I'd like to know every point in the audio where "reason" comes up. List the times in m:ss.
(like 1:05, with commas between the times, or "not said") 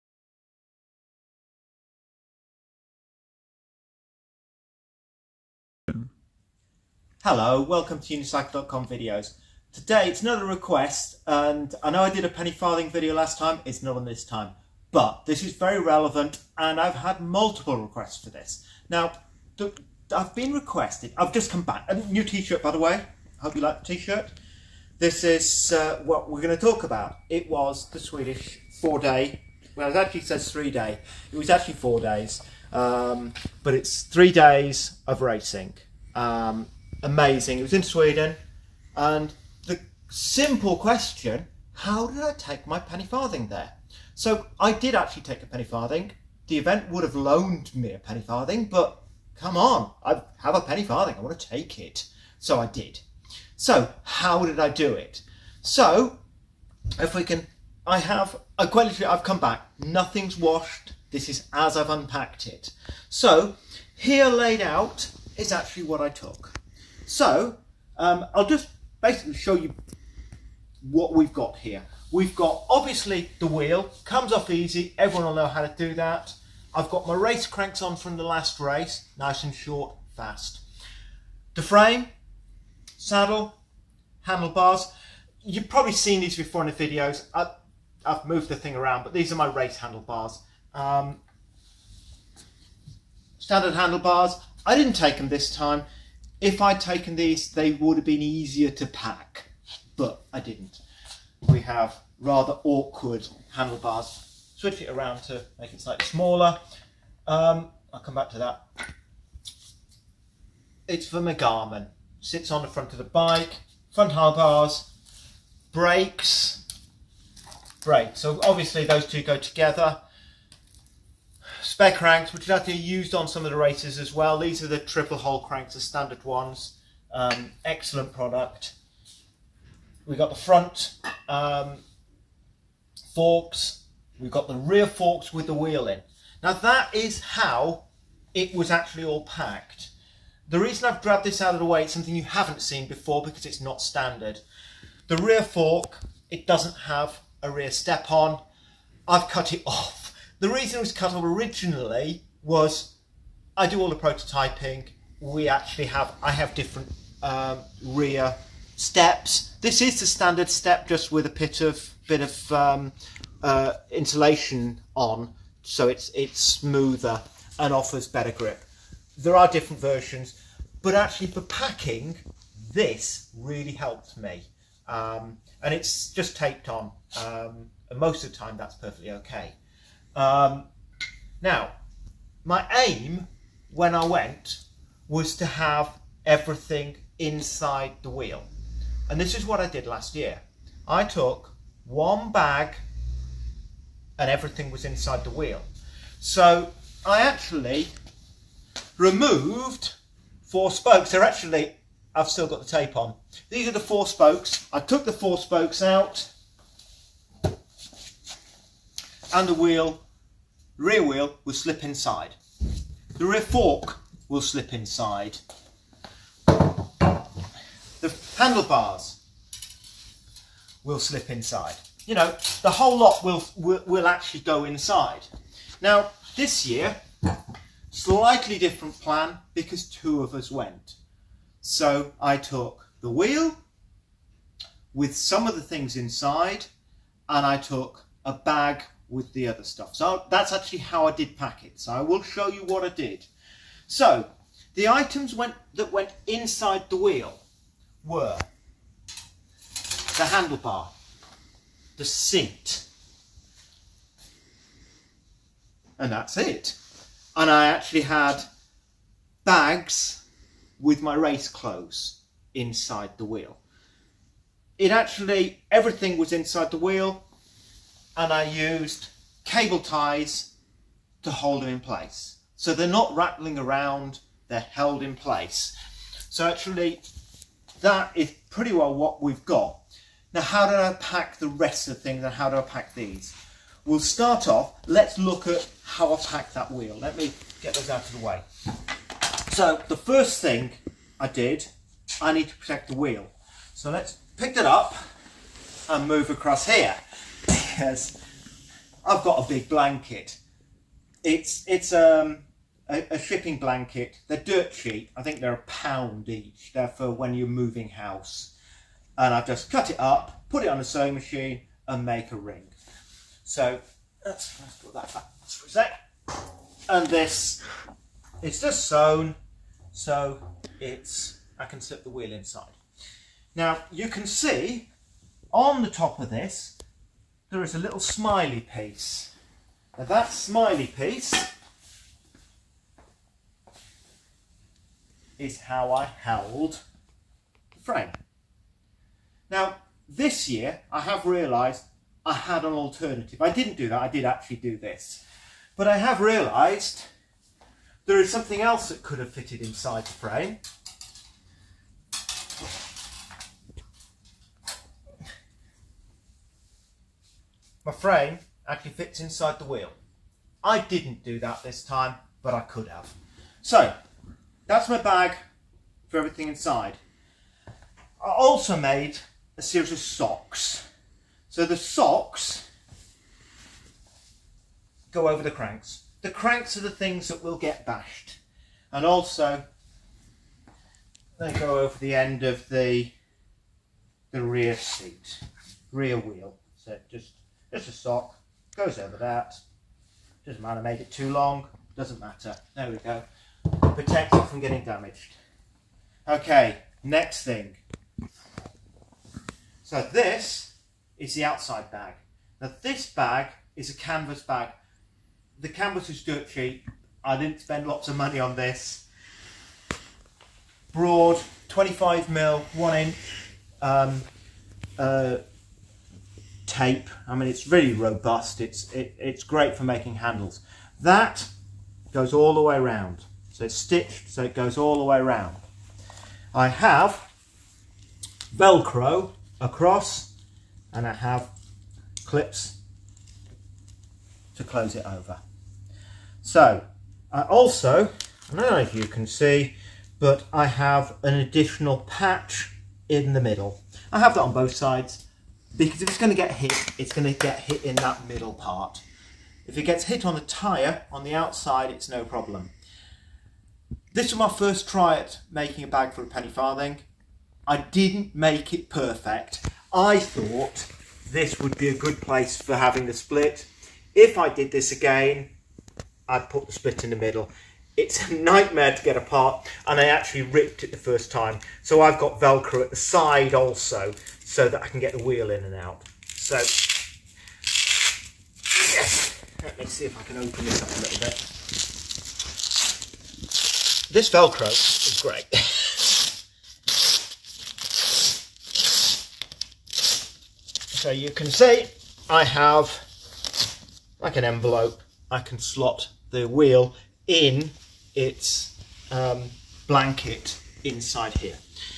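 2:20, 2:30.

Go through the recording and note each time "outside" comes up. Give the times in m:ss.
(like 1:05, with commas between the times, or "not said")
6:41, 7:31.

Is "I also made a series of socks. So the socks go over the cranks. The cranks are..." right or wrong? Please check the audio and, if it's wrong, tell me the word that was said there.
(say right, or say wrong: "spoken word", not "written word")
right.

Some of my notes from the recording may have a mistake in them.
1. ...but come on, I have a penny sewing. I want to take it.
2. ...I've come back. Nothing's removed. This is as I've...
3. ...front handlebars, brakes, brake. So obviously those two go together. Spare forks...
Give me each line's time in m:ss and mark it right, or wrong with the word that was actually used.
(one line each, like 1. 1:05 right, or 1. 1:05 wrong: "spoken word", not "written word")
1. 0:48 wrong: "farthing", not "sewing"
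2. 0:59 wrong: "washed", not "removed"
3. 1:53 wrong: "cranks", not "forks".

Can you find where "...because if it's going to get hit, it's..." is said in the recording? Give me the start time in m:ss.
7:25.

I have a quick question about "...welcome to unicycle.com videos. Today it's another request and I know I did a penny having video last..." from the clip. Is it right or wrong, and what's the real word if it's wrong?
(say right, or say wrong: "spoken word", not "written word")
wrong: "farthing", not "having".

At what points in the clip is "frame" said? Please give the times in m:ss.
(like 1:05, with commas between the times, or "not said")
1:21, 5:37, 5:50, 5:57.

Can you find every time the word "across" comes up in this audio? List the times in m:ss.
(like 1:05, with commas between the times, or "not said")
4:56, 7:09.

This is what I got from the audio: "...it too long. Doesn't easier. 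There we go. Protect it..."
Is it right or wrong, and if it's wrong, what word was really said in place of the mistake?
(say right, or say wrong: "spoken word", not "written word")
wrong: "matter", not "easier".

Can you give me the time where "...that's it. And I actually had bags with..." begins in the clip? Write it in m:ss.
4:16.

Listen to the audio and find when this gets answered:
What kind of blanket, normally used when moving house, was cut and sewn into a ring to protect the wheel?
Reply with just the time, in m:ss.
5:03.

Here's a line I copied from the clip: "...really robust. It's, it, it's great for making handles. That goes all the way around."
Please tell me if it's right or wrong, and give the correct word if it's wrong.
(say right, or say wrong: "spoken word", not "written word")
right.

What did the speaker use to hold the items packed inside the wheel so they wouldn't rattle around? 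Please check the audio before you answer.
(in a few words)
Cable ties.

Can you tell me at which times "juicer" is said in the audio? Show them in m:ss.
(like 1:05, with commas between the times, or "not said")
not said.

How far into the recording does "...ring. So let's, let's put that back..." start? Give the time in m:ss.
5:12.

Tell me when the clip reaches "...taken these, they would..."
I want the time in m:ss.
1:36.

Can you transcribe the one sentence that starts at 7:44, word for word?
If I did this again, I'd put the split in the middle.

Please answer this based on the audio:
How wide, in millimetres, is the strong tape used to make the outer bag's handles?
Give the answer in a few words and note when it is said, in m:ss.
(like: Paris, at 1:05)
25, at 6:51.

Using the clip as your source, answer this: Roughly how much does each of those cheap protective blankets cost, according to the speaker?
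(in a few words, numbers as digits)
£1.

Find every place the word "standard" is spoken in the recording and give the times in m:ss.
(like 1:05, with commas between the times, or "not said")
1:33, 2:05, 2:23, 2:40.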